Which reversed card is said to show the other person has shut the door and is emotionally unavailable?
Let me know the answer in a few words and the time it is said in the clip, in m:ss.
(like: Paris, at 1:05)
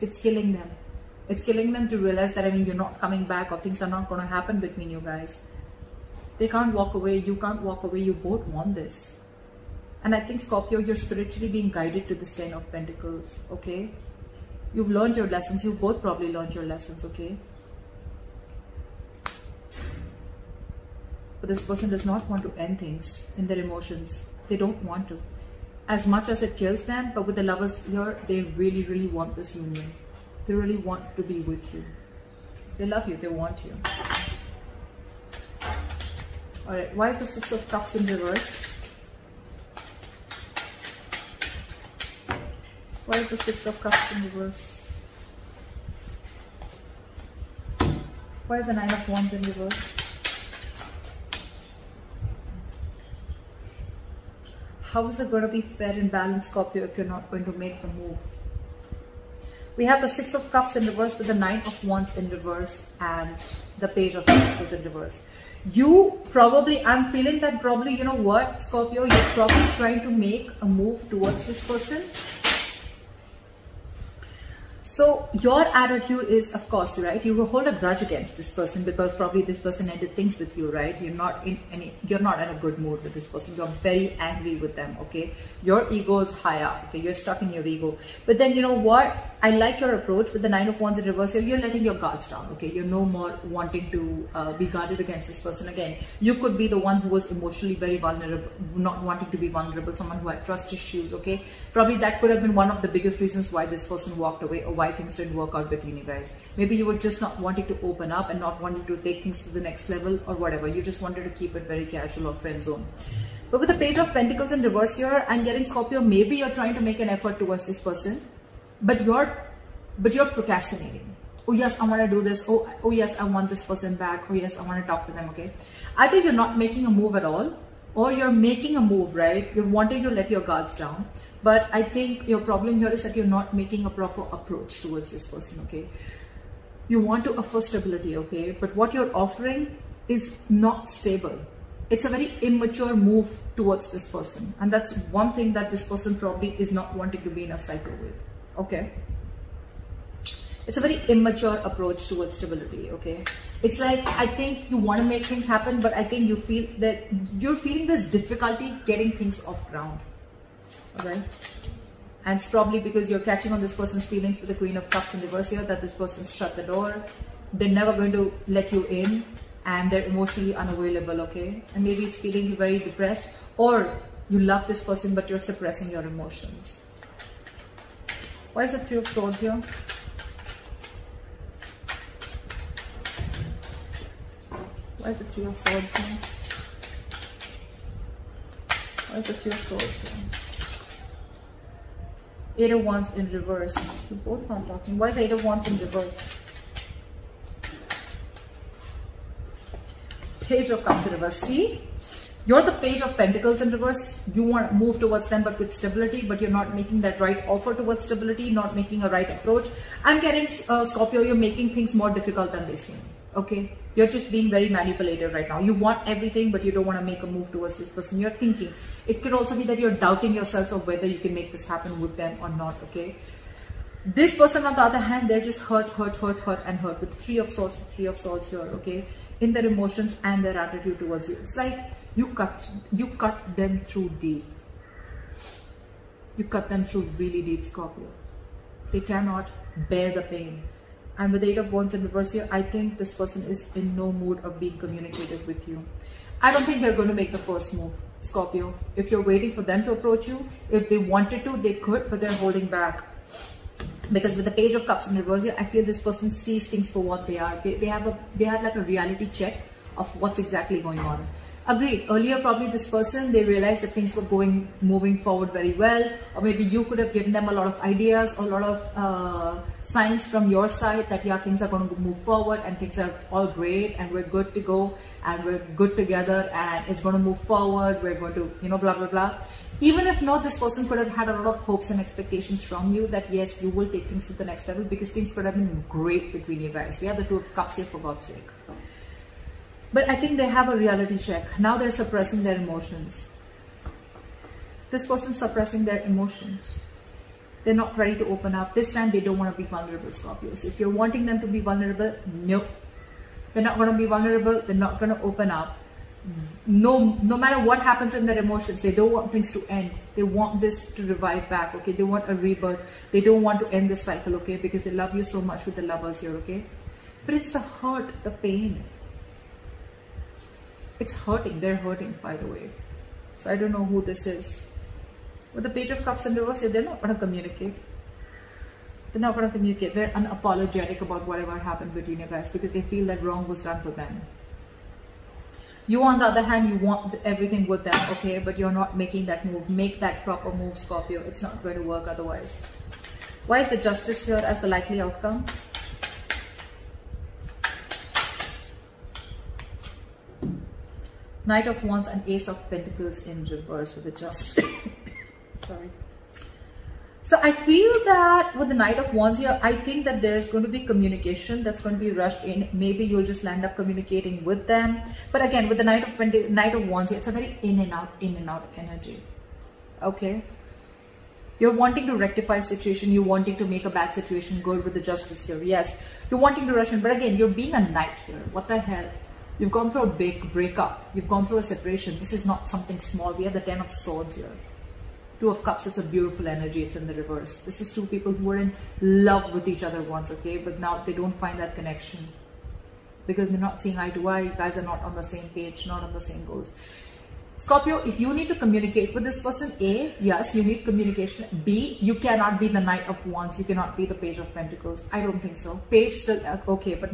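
Queen of Cups, at 2:44.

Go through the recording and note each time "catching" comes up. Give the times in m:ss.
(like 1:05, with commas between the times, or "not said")
2:43.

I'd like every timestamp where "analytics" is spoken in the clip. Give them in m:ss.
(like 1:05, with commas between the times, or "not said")
not said.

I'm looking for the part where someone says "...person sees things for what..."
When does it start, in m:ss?
4:16.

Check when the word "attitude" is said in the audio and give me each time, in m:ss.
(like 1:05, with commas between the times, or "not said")
1:15, 3:50.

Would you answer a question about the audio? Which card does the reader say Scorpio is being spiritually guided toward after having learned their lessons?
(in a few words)
Ten of Pentacles.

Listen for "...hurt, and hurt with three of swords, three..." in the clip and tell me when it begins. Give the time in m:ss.
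3:46.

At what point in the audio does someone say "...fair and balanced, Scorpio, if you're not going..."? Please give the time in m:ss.
0:55.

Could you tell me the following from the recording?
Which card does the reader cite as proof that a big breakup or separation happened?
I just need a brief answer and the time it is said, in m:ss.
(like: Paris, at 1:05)
Ten of Swords, at 6:23.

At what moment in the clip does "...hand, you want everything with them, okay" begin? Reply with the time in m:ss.
5:36.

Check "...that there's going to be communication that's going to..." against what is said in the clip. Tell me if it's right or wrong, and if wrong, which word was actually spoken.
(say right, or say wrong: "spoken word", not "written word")
right.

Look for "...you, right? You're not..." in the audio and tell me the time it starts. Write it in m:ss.
1:20.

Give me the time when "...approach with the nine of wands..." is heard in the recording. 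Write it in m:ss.
1:29.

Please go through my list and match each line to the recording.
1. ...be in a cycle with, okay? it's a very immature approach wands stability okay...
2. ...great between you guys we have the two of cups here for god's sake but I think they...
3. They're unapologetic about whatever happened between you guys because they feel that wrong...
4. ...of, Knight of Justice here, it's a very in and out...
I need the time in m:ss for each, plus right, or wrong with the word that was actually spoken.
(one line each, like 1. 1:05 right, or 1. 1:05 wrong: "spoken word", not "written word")
1. 2:27 wrong: "towards", not "wands"
2. 4:45 right
3. 5:29 right
4. 6:06 wrong: "Wands", not "Justice".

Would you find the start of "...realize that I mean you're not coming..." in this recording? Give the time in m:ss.
0:01.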